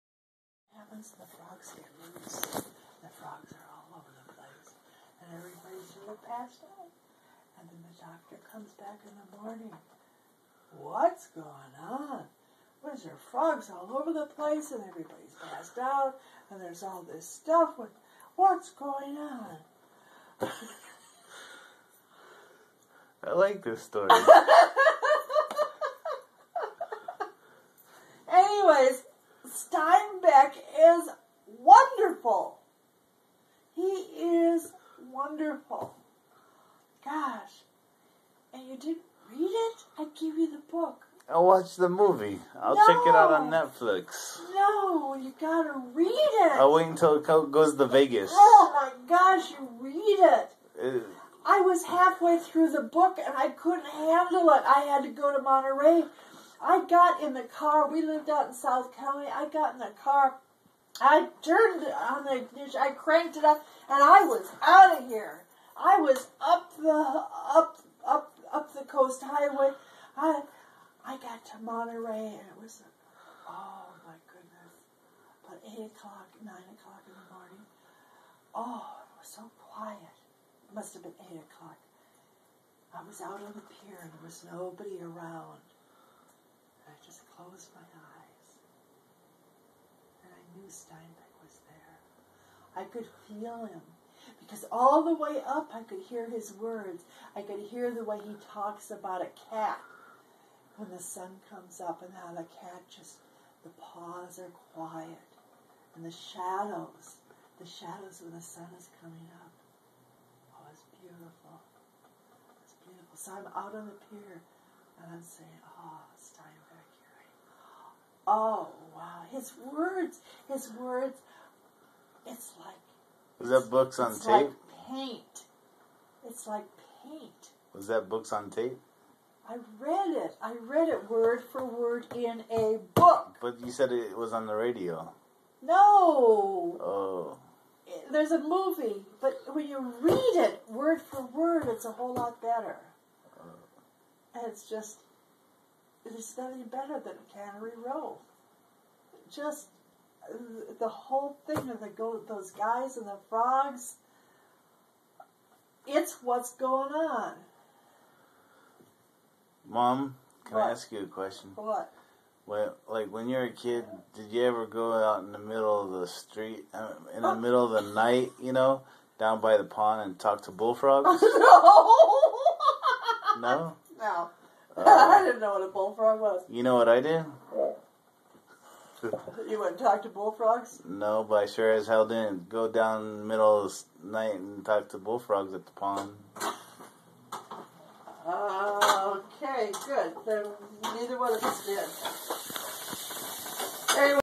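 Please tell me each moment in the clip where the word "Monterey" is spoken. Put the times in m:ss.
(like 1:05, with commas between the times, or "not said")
0:55, 1:11.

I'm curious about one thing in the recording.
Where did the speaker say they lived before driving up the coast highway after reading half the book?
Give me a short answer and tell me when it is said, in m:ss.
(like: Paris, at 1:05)
South County, at 0:58.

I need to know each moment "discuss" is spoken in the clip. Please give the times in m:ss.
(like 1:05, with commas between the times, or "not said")
not said.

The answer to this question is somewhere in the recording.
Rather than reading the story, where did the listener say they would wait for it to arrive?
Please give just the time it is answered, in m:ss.
0:47.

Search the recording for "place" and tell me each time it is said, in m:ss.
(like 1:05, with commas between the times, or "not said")
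0:04, 0:14.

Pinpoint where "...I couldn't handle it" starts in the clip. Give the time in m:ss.
0:53.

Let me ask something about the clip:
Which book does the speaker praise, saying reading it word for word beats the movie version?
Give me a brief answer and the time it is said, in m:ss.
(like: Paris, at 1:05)
Cannery Row, at 2:27.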